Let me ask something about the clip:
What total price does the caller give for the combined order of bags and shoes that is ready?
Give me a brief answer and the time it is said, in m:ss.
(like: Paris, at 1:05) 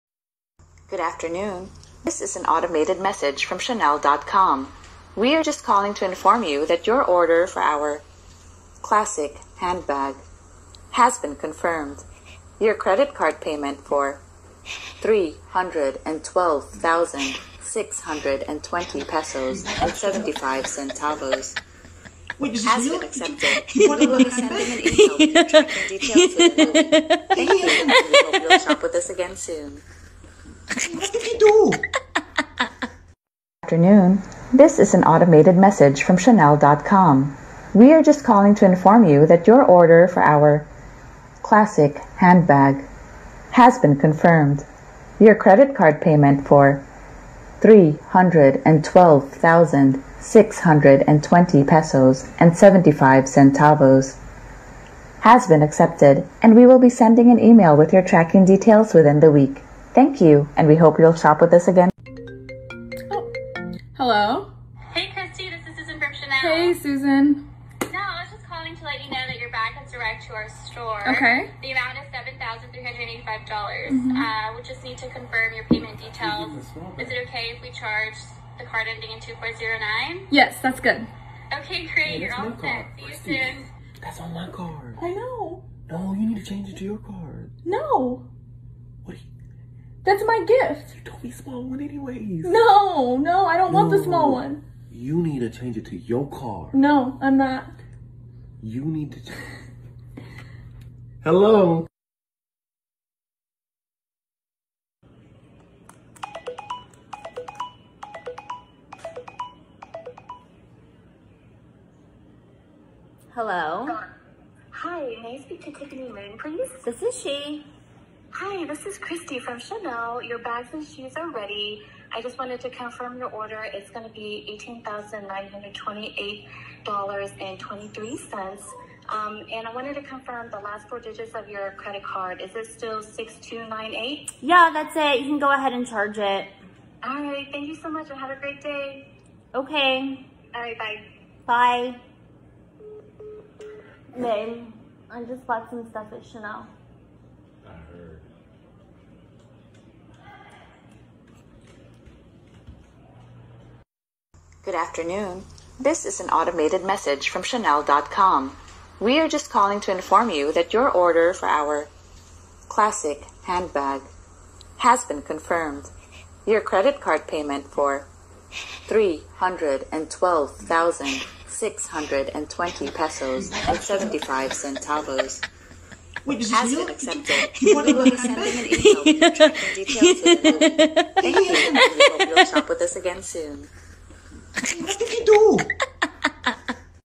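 $18,928.23, at 2:04.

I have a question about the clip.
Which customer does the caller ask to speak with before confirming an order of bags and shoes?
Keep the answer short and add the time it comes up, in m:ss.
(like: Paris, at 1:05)
Tiffany Moon, at 1:55.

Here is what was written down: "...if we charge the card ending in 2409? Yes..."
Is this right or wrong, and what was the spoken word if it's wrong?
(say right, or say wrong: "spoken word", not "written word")
right.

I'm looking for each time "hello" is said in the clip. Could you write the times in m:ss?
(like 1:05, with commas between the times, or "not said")
1:03, 1:41, 1:53.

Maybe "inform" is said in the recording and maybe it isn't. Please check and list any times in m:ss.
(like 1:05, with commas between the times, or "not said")
0:06, 0:38, 2:39.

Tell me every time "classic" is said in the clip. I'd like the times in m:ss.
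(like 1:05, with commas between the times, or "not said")
0:08, 0:41, 2:42.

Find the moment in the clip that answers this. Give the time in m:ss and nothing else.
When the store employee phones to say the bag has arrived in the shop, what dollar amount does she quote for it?
1:12.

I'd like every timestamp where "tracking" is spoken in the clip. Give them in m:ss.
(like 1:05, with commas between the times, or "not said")
0:25, 0:58.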